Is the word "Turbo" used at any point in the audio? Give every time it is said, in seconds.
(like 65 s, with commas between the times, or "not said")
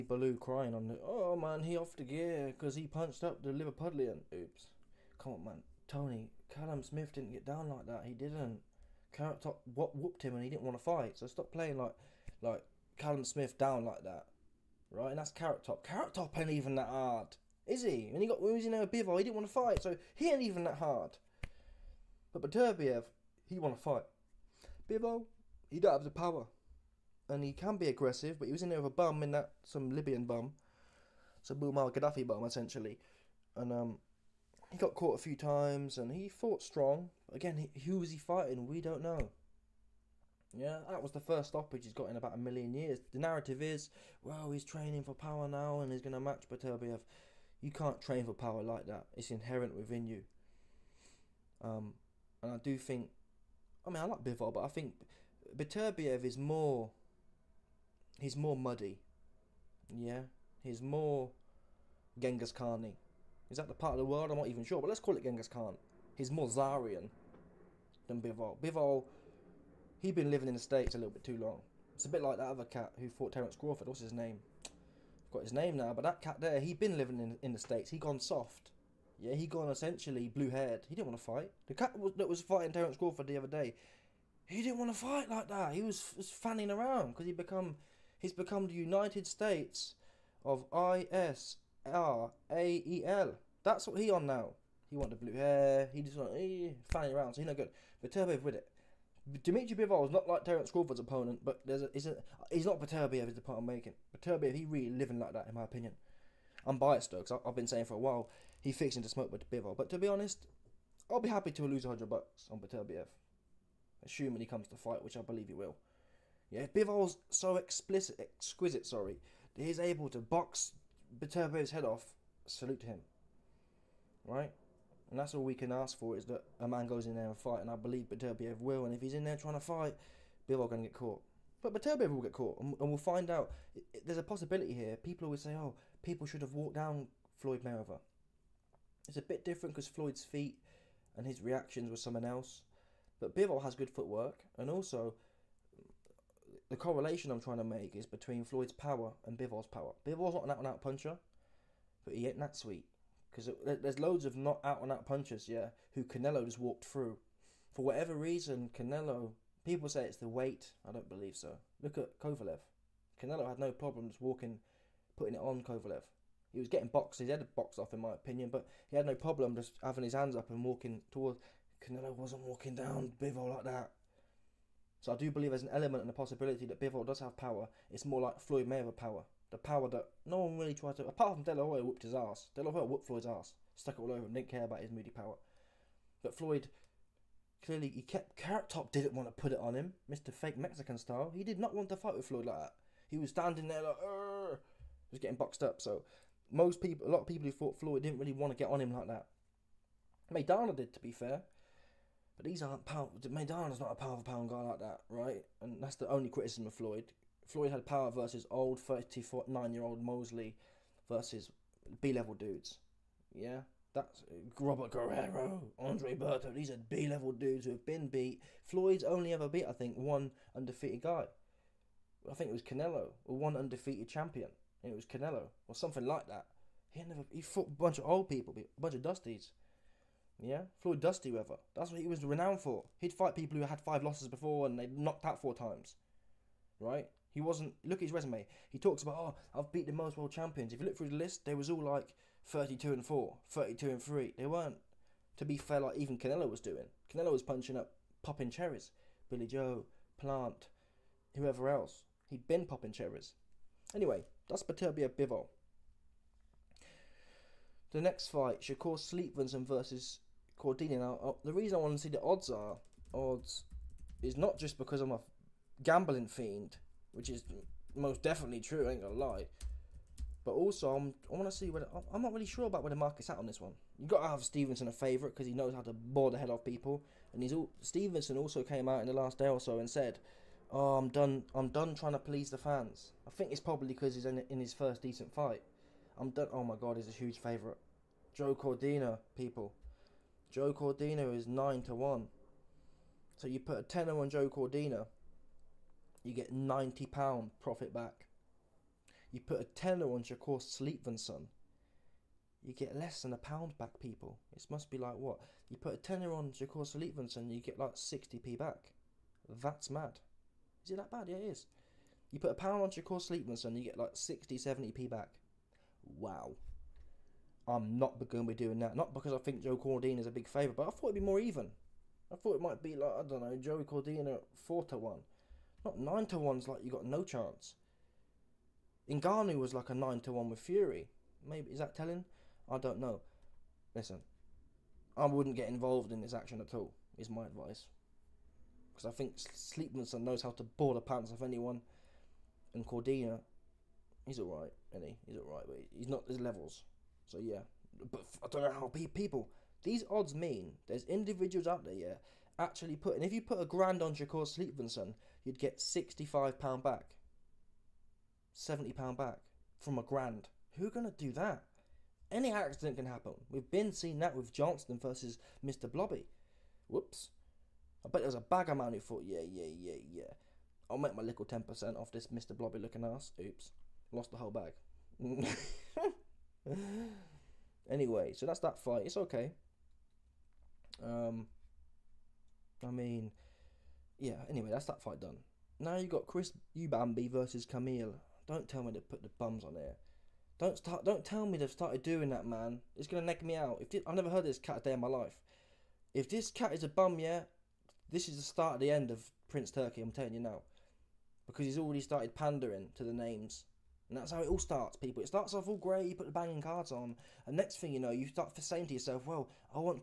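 98 s.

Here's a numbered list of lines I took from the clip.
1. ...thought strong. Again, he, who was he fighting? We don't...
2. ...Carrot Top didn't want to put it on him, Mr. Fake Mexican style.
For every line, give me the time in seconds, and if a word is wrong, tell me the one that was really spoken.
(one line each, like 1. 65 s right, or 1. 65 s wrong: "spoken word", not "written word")
1. 36 s wrong: "fought", not "thought"
2. 188 s right.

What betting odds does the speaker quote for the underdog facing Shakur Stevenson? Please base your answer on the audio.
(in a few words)
9 to 1.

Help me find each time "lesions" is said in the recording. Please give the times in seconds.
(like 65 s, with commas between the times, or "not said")
not said.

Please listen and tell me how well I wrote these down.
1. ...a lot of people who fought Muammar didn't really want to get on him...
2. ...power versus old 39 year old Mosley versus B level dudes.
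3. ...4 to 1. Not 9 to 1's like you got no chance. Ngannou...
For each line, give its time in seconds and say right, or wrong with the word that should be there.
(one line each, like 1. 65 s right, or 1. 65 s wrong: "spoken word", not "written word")
1. 197 s wrong: "Floyd", not "Muammar"
2. 207 s right
3. 324 s right.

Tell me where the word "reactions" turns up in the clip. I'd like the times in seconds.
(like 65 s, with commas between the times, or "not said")
141 s.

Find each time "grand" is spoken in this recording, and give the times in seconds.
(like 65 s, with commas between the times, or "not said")
353 s, 360 s.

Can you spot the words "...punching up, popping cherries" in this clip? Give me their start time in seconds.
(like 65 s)
247 s.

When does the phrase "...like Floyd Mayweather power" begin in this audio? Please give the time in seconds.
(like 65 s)
178 s.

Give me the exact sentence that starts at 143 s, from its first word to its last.
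But Bivol has good footwork, and also the correlation I'm trying to make is between Floyd's power and Bivol's power.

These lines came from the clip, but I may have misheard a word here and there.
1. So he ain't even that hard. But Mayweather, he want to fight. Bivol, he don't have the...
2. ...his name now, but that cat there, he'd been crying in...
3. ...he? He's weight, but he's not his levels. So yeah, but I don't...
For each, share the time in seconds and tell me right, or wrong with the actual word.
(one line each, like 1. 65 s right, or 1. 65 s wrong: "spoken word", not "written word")
1. 19 s wrong: "Beterbiev", not "Mayweather"
2. 75 s wrong: "living", not "crying"
3. 345 s wrong: "alright", not "weight".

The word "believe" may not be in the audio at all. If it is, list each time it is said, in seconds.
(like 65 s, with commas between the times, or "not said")
115 s, 127 s, 161 s, 175 s.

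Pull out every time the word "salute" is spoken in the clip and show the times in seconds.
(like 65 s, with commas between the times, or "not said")
122 s.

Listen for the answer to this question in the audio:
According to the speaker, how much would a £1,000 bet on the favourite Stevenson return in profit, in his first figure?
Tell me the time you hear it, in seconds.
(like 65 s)
355 s.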